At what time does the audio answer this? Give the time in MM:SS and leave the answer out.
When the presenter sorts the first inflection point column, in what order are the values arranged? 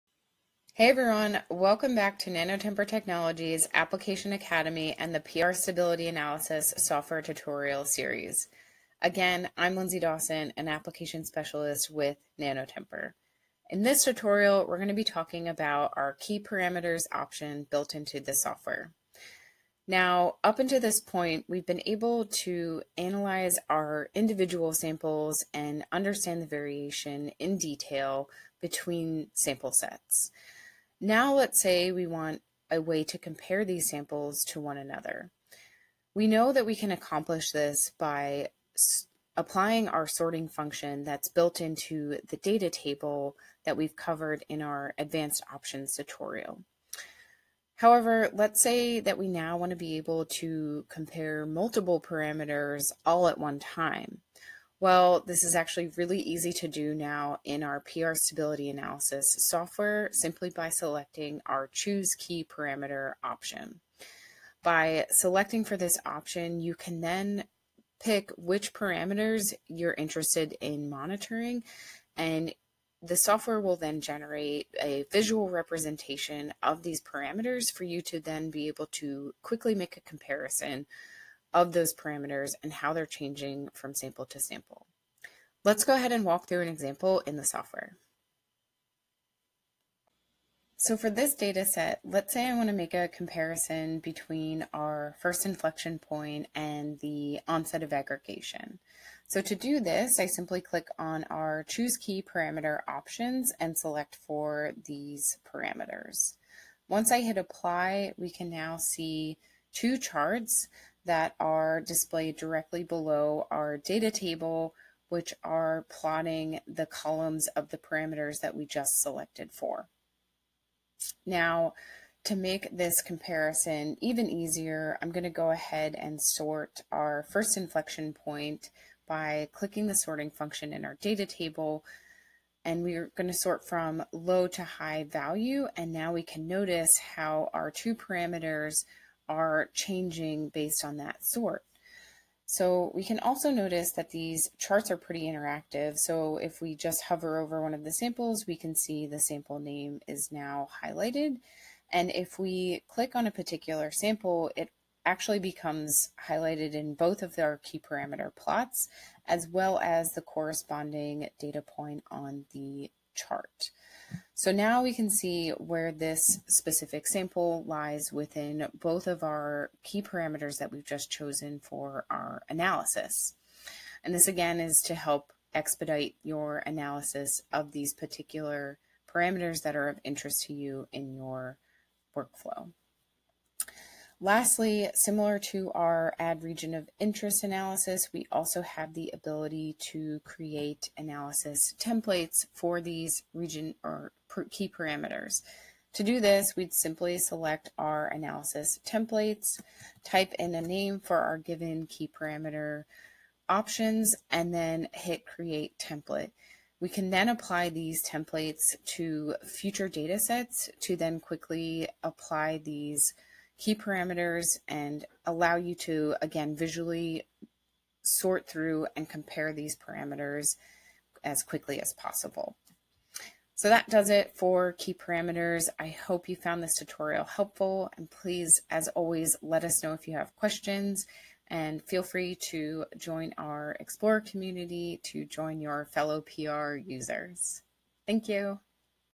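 02:14.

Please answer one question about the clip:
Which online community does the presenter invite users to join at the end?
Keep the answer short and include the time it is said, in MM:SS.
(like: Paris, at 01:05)
Explorer community, at 03:53.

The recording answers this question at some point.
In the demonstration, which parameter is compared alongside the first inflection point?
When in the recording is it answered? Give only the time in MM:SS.
01:37.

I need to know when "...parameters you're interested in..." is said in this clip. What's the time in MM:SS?
01:08.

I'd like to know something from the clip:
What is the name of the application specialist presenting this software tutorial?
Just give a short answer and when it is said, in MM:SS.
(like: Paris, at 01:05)
Lindsay Dawson, at 00:09.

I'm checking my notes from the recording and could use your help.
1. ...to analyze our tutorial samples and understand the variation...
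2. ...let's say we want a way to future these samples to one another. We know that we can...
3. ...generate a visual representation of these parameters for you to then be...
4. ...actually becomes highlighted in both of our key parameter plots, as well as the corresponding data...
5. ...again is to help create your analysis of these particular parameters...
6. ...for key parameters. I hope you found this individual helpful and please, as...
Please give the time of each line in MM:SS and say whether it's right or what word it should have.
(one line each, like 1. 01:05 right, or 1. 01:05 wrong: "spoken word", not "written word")
1. 00:22 wrong: "individual", not "tutorial"
2. 00:31 wrong: "compare", not "future"
3. 01:14 right
4. 02:35 right
5. 02:54 wrong: "expedite", not "create"
6. 03:44 wrong: "tutorial", not "individual".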